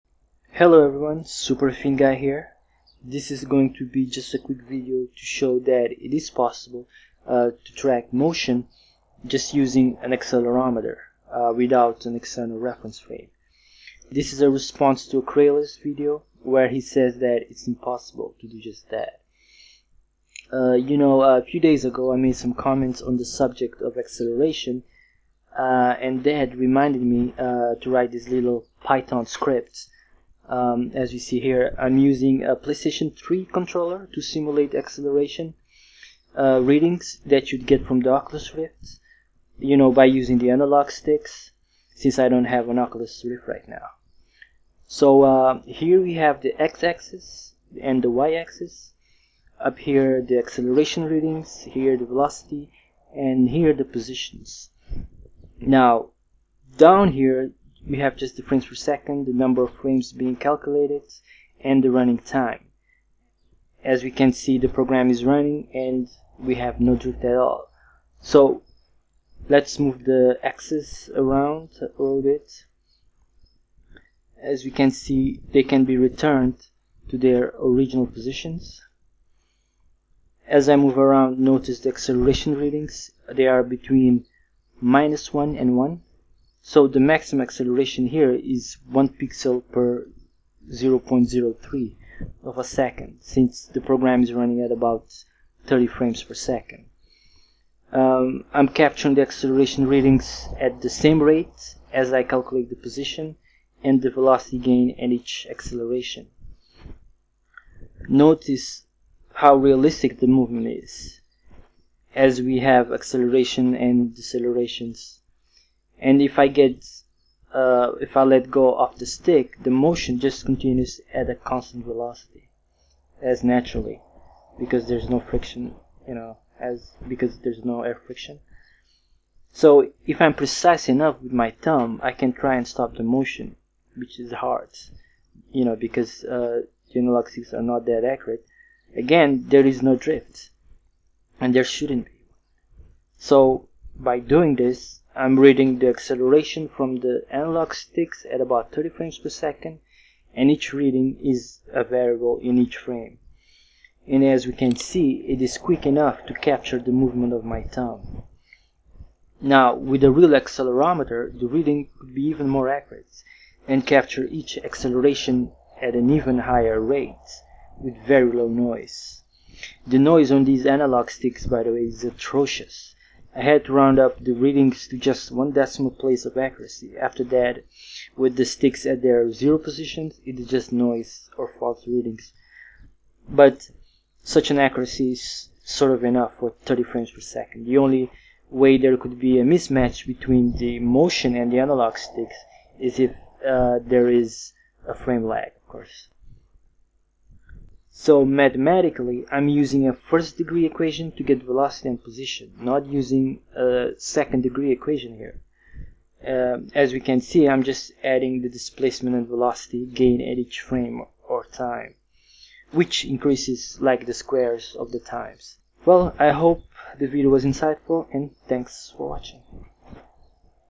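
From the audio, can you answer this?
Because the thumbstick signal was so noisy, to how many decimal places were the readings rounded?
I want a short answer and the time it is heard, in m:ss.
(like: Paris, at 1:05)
1, at 2:55.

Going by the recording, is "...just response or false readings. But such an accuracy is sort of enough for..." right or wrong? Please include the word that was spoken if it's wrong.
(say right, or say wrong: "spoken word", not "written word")
wrong: "noise", not "response".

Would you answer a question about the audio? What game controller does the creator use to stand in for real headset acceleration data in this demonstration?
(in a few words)
PlayStation 3 controller.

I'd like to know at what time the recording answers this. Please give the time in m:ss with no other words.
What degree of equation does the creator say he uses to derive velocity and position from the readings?
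3:19.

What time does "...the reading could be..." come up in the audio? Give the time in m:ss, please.
2:41.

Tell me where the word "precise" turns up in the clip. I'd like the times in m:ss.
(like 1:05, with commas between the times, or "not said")
2:10.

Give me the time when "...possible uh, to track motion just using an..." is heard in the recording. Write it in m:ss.
0:06.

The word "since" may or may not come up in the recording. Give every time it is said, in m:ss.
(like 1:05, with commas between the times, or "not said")
0:41, 1:33.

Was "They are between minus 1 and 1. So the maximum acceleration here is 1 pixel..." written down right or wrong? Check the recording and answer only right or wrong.
right.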